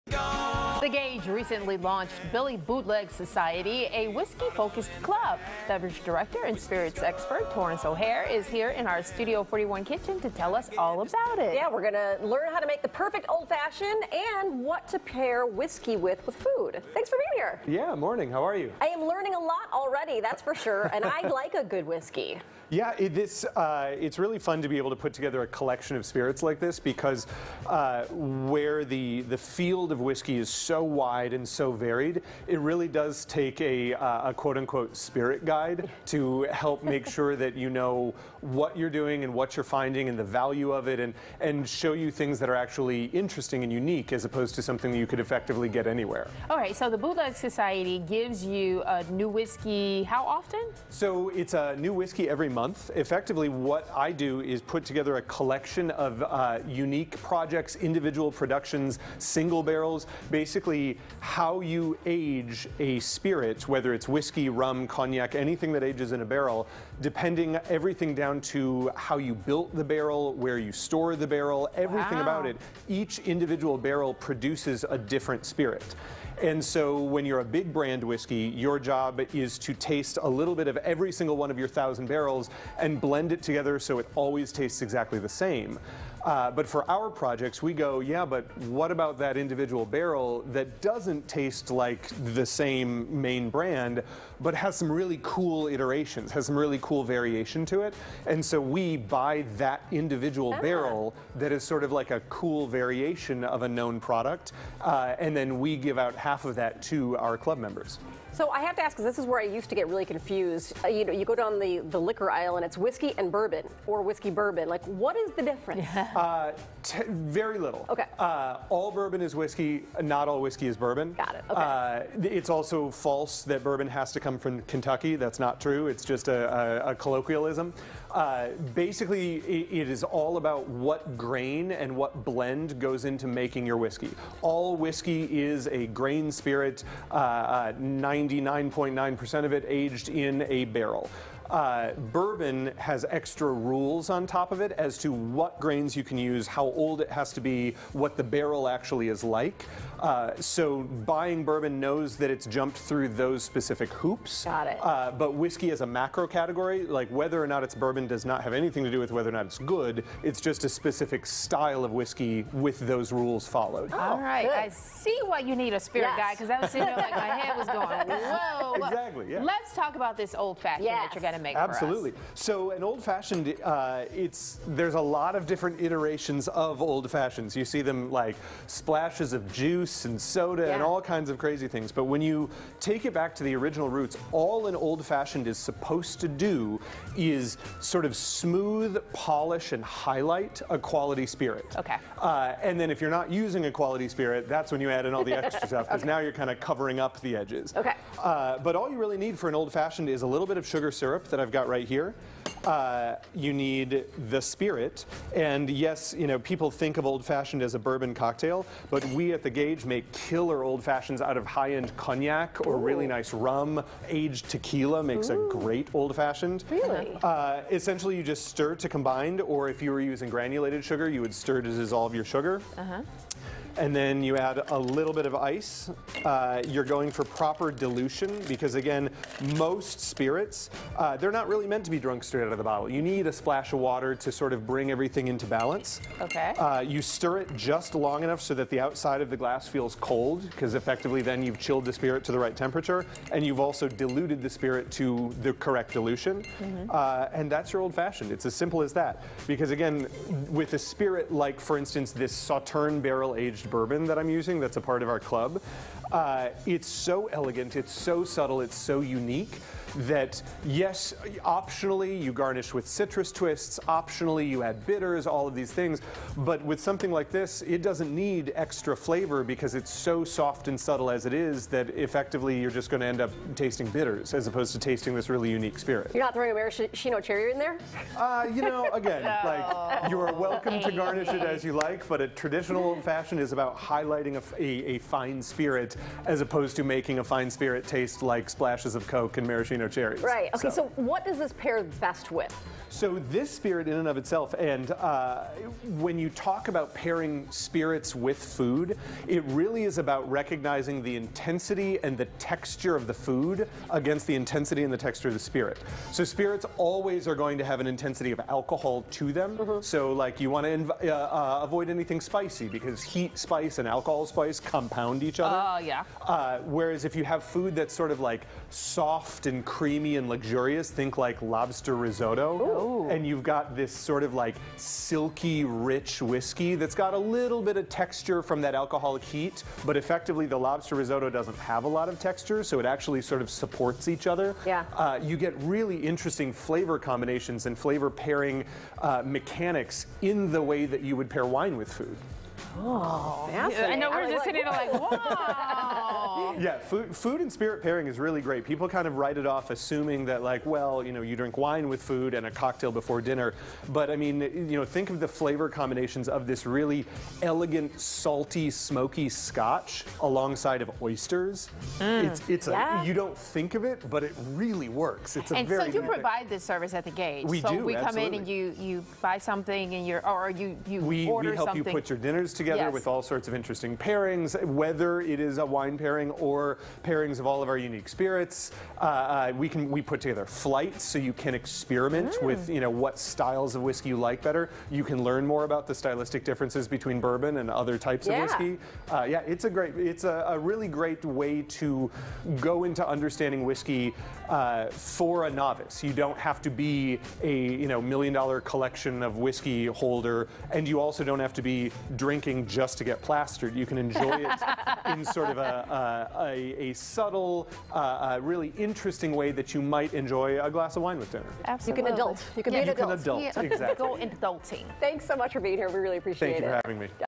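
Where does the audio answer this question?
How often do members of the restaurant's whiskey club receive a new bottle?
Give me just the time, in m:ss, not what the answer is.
0:52.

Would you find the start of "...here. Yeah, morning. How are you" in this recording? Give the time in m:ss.
0:17.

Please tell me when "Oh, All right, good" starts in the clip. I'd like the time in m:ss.
2:43.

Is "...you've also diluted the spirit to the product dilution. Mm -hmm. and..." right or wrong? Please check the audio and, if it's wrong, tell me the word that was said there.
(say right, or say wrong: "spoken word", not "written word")
wrong: "correct", not "product".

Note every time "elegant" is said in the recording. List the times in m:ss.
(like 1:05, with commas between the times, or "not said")
4:17, 5:57.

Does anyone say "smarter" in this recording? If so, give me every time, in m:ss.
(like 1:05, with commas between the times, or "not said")
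not said.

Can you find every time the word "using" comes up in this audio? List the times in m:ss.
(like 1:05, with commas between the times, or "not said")
3:13, 3:40, 4:14.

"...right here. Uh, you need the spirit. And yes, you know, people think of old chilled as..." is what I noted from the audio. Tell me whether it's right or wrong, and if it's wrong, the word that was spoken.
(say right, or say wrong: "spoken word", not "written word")
wrong: "fashioned", not "chilled".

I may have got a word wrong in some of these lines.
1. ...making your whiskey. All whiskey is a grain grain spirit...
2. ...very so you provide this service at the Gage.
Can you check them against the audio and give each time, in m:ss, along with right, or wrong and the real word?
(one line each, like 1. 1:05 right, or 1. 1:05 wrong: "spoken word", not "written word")
1. 2:13 right
2. 6:05 right.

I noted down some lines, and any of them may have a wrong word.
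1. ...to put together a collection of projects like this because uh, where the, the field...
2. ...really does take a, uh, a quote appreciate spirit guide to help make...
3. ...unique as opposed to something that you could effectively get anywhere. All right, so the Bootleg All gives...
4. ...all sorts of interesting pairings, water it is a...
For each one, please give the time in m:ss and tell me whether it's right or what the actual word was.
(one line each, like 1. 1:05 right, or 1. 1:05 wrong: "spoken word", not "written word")
1. 0:24 wrong: "spirits", not "projects"
2. 0:32 wrong: "unquote", not "appreciate"
3. 0:43 wrong: "Society", not "All"
4. 6:13 wrong: "whether", not "water".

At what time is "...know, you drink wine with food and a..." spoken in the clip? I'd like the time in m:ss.
5:51.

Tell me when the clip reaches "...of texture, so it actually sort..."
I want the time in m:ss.
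5:32.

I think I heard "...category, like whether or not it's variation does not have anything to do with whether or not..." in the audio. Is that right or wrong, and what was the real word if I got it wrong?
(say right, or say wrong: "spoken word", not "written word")
wrong: "bourbon", not "variation".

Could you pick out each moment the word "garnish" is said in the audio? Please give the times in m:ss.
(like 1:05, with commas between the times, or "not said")
4:22, 4:40.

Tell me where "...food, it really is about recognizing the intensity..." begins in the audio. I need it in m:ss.
4:58.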